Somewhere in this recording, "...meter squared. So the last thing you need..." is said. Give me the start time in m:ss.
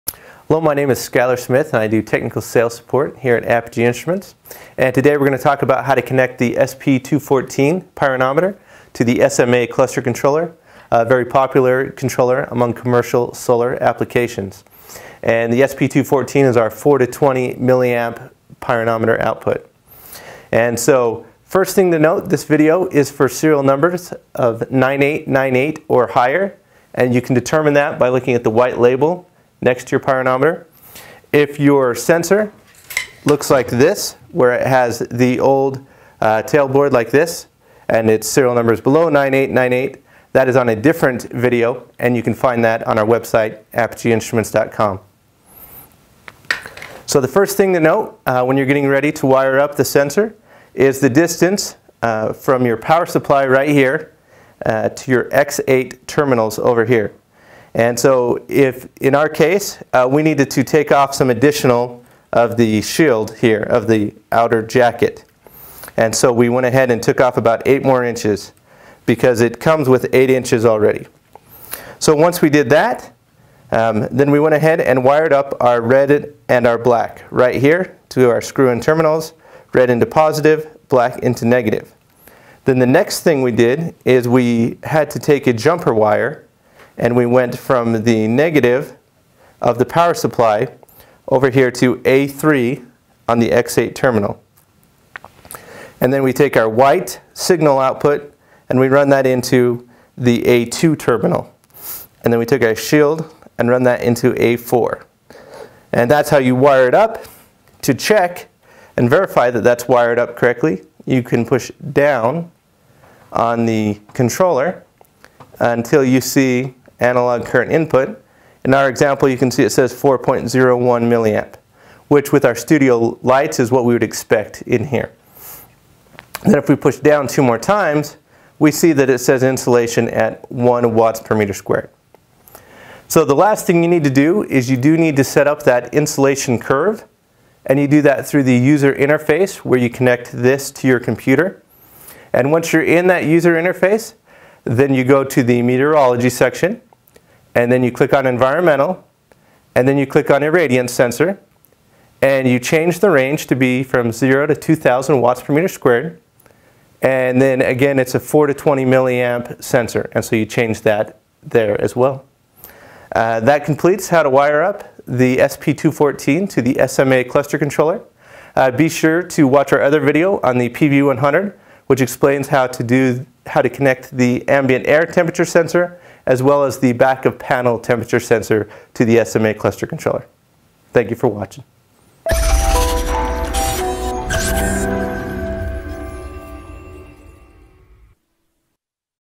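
2:11.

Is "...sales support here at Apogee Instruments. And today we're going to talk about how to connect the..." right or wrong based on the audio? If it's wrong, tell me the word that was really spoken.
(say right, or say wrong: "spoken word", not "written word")
right.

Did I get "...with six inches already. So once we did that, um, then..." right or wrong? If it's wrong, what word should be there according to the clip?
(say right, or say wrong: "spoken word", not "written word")
wrong: "eight", not "six".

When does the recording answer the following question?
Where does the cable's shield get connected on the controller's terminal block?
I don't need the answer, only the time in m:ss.
1:44.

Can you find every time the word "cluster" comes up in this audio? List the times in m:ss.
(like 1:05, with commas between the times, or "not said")
0:09, 2:47, 2:59.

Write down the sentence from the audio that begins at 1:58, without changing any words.
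In our example, you can see it says 4.01 milliamp, which with our studio lights is what we would expect in here.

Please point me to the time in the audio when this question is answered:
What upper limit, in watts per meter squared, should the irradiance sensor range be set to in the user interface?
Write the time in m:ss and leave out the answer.
2:34.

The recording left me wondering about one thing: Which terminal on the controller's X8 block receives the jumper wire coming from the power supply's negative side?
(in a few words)
A3.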